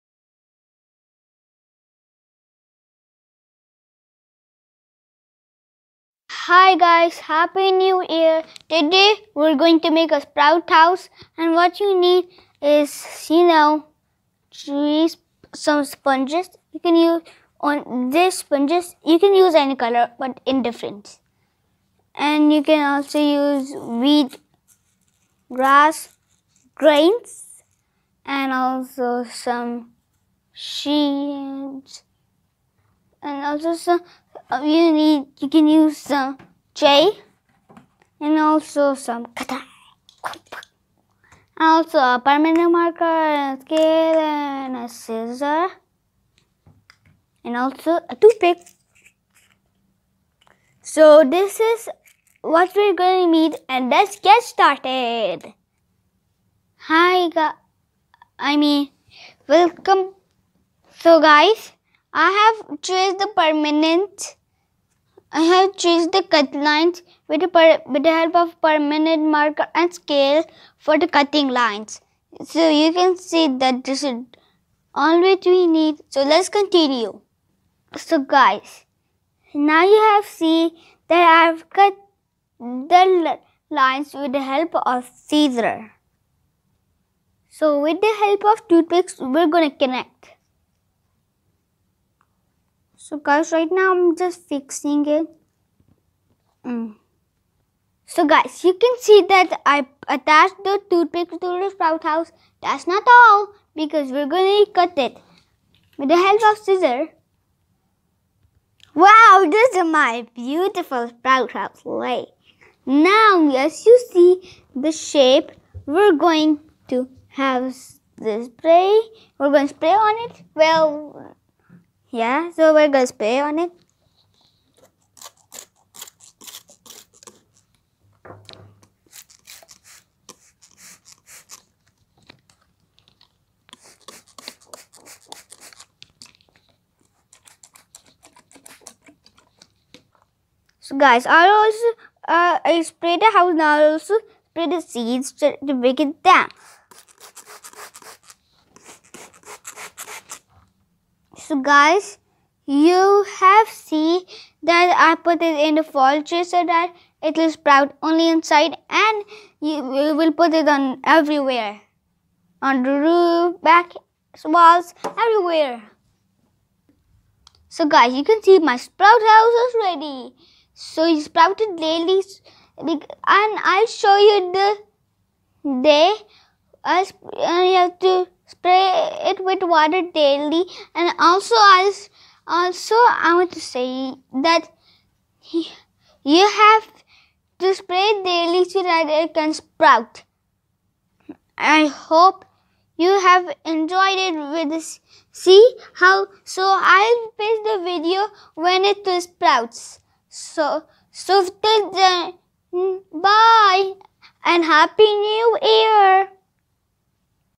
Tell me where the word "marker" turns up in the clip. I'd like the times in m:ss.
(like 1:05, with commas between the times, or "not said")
0:42, 1:09.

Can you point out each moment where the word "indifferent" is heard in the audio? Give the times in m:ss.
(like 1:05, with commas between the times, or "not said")
0:20.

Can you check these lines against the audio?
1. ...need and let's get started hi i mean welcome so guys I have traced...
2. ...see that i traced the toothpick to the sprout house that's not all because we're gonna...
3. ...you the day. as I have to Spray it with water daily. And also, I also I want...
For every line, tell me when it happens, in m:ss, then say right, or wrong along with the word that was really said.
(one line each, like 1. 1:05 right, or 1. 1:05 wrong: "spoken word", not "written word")
1. 0:53 right
2. 1:39 wrong: "attached", not "traced"
3. 2:54 right.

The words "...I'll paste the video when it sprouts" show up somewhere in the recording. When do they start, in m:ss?
3:16.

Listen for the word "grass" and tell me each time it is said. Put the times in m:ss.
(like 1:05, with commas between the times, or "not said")
0:25.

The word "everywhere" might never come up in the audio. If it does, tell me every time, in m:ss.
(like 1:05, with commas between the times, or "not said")
2:41, 2:45.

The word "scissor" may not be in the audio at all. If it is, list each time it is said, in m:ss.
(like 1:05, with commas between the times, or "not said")
0:44, 1:25, 1:46.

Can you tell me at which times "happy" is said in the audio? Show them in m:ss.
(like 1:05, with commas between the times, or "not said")
0:07, 3:24.